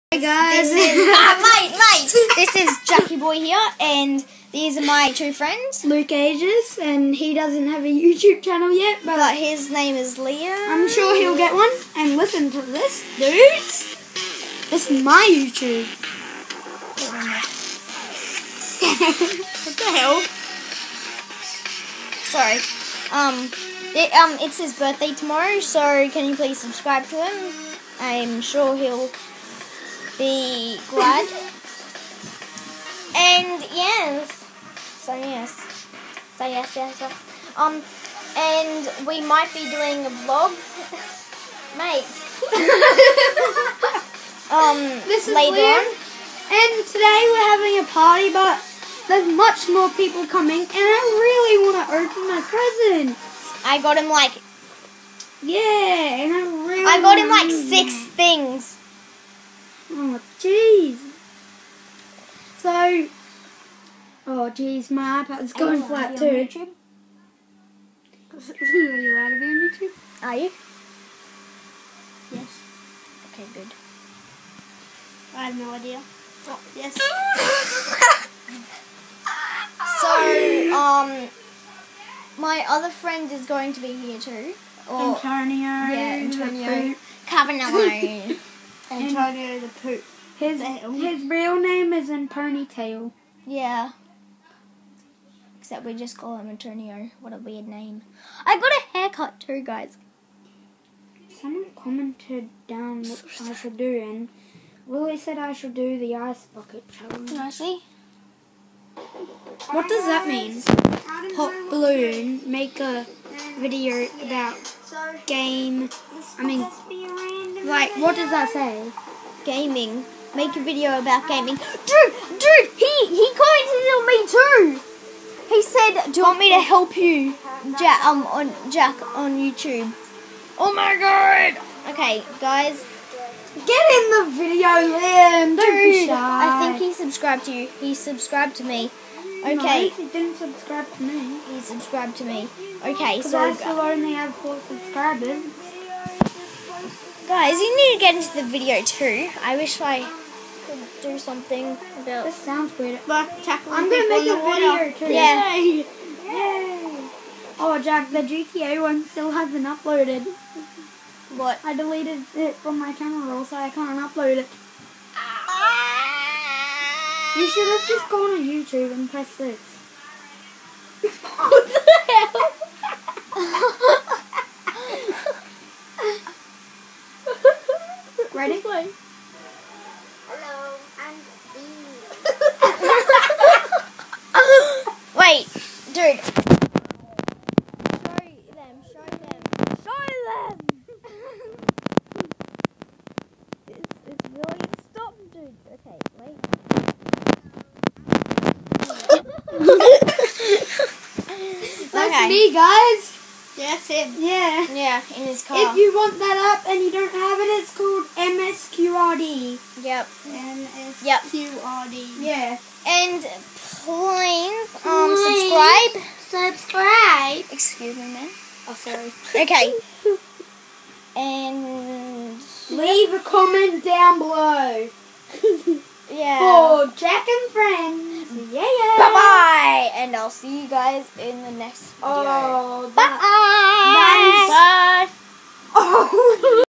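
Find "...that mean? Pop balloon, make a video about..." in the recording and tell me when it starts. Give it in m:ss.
1:50.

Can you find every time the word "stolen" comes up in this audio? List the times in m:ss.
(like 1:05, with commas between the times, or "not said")
not said.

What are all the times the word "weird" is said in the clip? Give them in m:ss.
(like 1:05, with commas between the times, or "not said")
1:37, 2:32.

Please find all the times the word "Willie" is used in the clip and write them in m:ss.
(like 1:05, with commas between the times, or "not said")
1:44.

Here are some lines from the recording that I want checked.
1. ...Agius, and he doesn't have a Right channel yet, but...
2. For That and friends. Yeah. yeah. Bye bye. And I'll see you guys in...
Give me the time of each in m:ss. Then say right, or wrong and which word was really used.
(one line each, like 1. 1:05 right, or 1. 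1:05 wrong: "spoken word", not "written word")
1. 0:06 wrong: "YouTube", not "Right"
2. 3:46 wrong: "Jack", not "That".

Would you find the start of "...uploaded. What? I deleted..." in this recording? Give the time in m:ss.
2:39.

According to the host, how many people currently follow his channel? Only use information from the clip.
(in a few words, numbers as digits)
4.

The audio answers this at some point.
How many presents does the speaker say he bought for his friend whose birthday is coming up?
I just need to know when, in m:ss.
0:57.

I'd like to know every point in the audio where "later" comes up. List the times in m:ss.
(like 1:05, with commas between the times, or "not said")
0:45.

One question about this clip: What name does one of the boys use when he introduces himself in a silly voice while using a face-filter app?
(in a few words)
Steve.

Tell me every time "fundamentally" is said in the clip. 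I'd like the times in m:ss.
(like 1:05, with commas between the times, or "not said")
not said.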